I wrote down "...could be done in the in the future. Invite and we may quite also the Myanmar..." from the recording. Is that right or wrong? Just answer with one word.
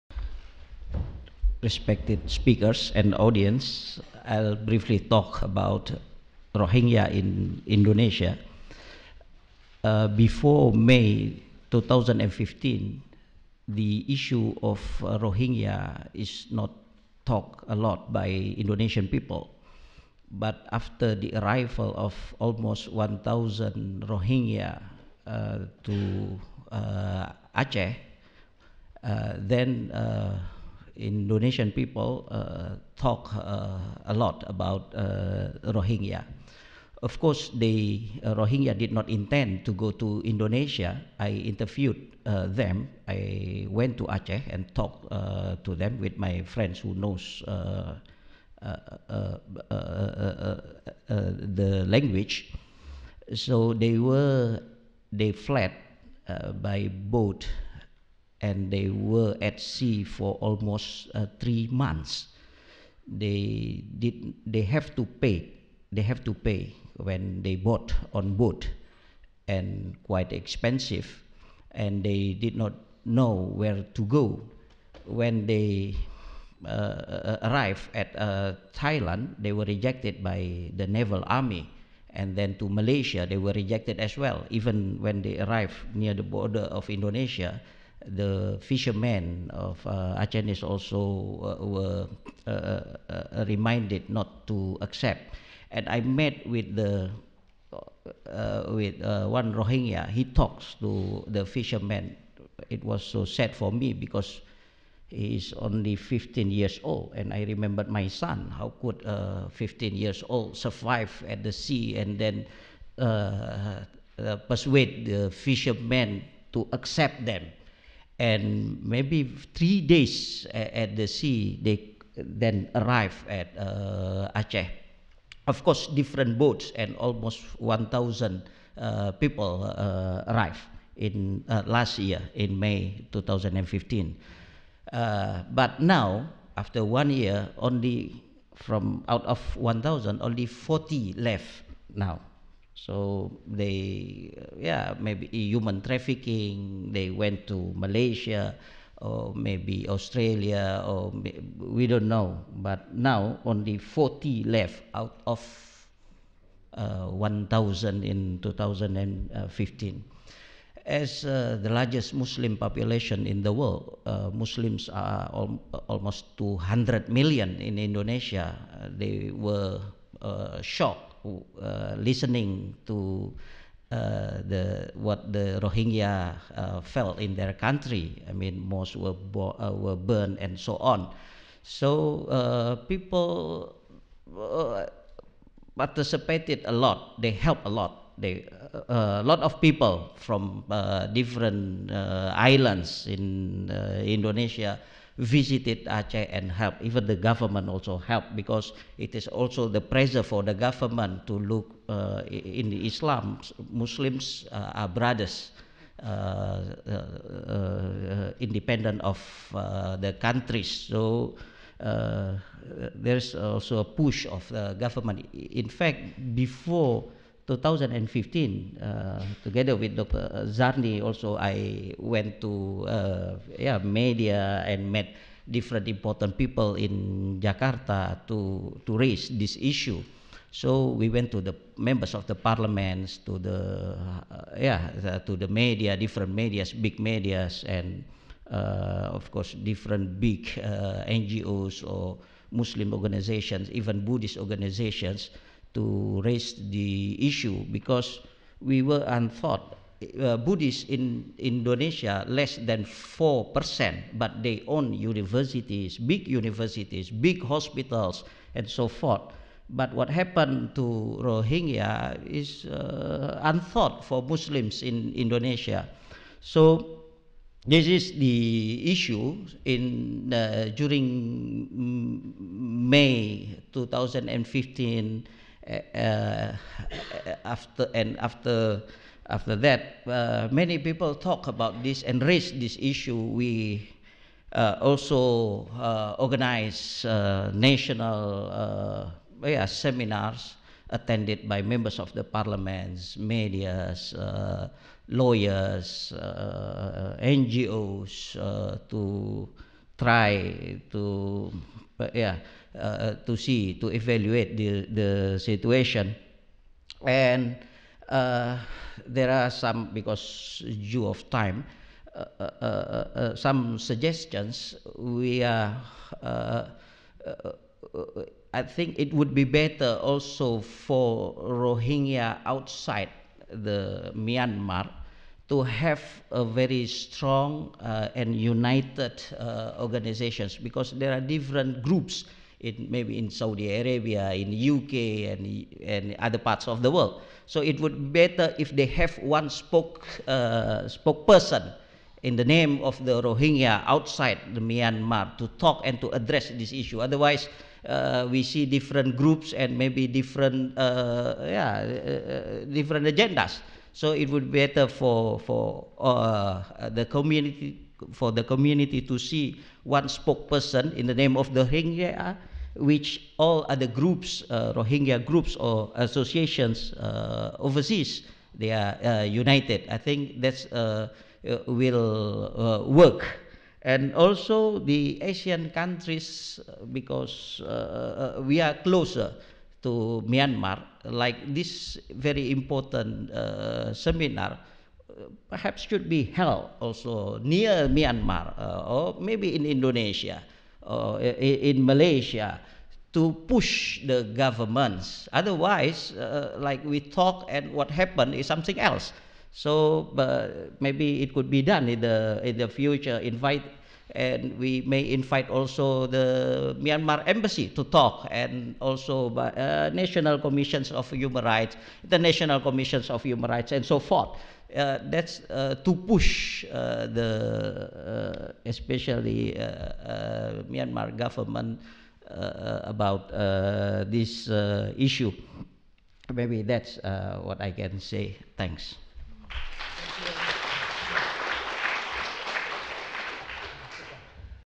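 wrong.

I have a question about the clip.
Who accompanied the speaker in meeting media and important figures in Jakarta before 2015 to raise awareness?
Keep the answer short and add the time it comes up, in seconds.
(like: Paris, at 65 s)
Dr. Zarni, at 219 s.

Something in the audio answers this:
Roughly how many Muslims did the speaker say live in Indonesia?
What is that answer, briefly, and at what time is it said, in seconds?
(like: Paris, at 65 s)
almost 200 million, at 165 s.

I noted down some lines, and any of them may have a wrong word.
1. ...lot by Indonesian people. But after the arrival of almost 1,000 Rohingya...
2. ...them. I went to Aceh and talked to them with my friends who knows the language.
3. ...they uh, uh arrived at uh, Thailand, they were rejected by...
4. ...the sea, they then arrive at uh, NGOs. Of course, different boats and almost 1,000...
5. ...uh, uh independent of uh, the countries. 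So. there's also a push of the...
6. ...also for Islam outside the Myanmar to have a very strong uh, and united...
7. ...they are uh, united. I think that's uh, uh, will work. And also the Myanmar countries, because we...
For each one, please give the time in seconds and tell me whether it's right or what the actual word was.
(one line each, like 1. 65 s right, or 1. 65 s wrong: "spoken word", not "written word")
1. 17 s right
2. 42 s right
3. 75 s right
4. 120 s wrong: "Aceh", not "NGOs"
5. 206 s right
6. 320 s wrong: "Rohingya", not "Islam"
7. 368 s wrong: "ASEAN", not "Myanmar".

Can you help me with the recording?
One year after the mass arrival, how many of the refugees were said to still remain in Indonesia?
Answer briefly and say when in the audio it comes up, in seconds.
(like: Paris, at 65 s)
40, at 140 s.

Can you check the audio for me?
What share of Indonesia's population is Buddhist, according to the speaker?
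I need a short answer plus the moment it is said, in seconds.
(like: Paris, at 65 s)
less than 4%, at 252 s.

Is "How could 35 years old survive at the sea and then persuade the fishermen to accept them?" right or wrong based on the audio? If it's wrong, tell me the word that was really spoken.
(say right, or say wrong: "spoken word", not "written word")
wrong: "15", not "35".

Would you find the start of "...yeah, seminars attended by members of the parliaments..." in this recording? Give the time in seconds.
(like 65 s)
289 s.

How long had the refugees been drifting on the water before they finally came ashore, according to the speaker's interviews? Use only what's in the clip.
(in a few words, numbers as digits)
almost 3 months.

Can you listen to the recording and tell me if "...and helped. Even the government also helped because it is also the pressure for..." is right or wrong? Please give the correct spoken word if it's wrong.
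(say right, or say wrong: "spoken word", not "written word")
right.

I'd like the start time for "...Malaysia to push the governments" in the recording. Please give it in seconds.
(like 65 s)
391 s.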